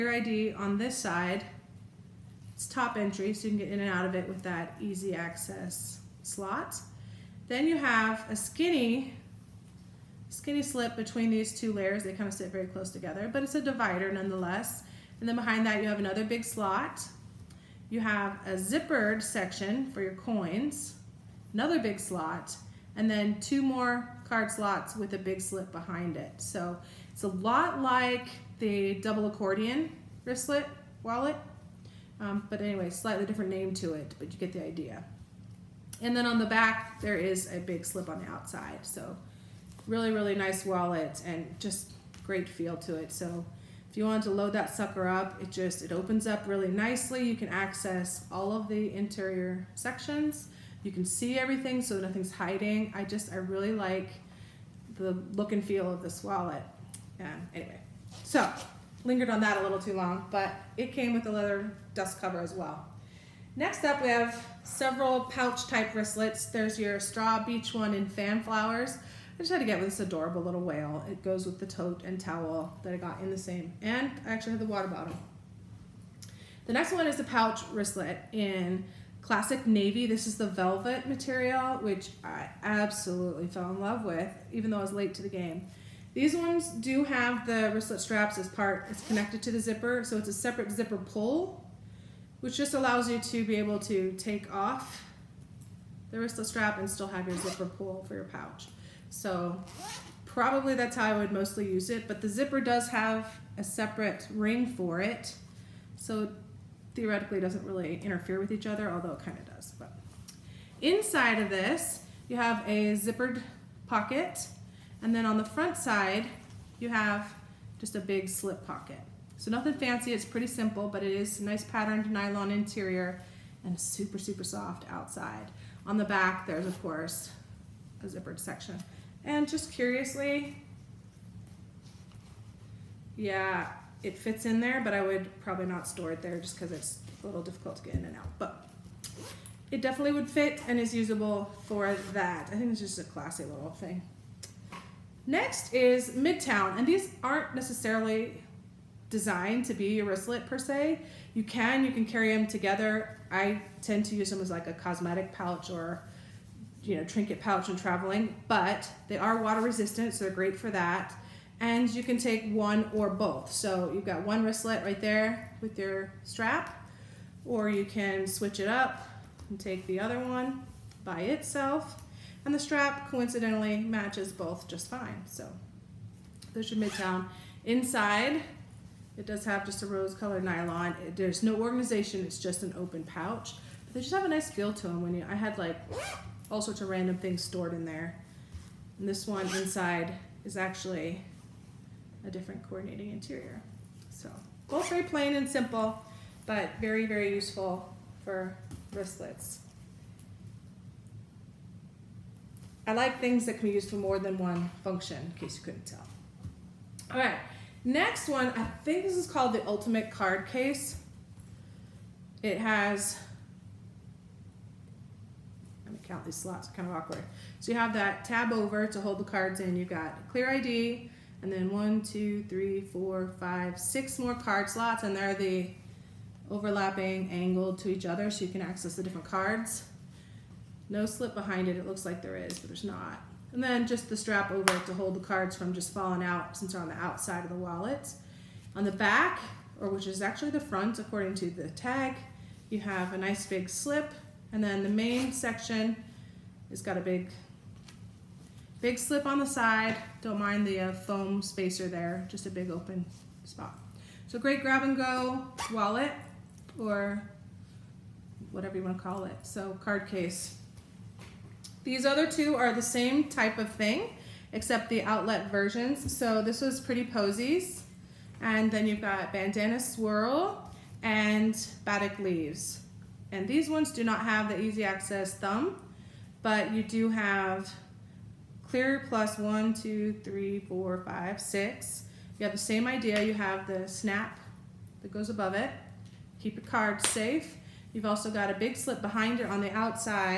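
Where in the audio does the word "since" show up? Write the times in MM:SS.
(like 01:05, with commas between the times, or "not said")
03:56.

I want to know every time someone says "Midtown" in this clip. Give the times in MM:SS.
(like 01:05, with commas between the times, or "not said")
02:26, 02:56.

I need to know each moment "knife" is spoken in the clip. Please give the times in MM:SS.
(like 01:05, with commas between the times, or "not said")
not said.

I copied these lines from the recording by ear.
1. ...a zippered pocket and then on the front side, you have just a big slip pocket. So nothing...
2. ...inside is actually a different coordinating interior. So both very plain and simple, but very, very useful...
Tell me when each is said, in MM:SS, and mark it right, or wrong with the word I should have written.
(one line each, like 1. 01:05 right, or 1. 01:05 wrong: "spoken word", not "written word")
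1. 01:52 right
2. 03:09 right.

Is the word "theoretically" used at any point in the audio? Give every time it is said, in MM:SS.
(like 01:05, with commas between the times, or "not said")
01:46.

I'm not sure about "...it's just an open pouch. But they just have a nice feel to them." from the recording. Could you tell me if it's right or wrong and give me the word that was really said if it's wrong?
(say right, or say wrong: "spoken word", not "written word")
right.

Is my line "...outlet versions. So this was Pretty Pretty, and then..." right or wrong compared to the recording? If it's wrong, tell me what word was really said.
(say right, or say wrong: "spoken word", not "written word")
wrong: "Posies", not "Pretty".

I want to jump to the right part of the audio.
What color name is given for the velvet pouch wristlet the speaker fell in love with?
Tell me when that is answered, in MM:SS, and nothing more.
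01:19.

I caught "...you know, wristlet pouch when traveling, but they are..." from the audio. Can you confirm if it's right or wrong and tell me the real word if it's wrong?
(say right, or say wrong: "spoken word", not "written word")
wrong: "trinket", not "wristlet".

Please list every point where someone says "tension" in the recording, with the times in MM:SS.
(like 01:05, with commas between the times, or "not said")
not said.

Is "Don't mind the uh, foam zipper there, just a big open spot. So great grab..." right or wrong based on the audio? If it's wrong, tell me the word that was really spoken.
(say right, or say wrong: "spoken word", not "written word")
wrong: "spacer", not "zipper".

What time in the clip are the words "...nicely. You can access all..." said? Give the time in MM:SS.
00:46.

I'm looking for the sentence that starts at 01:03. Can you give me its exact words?
Next up, we have several pouch type wristlets.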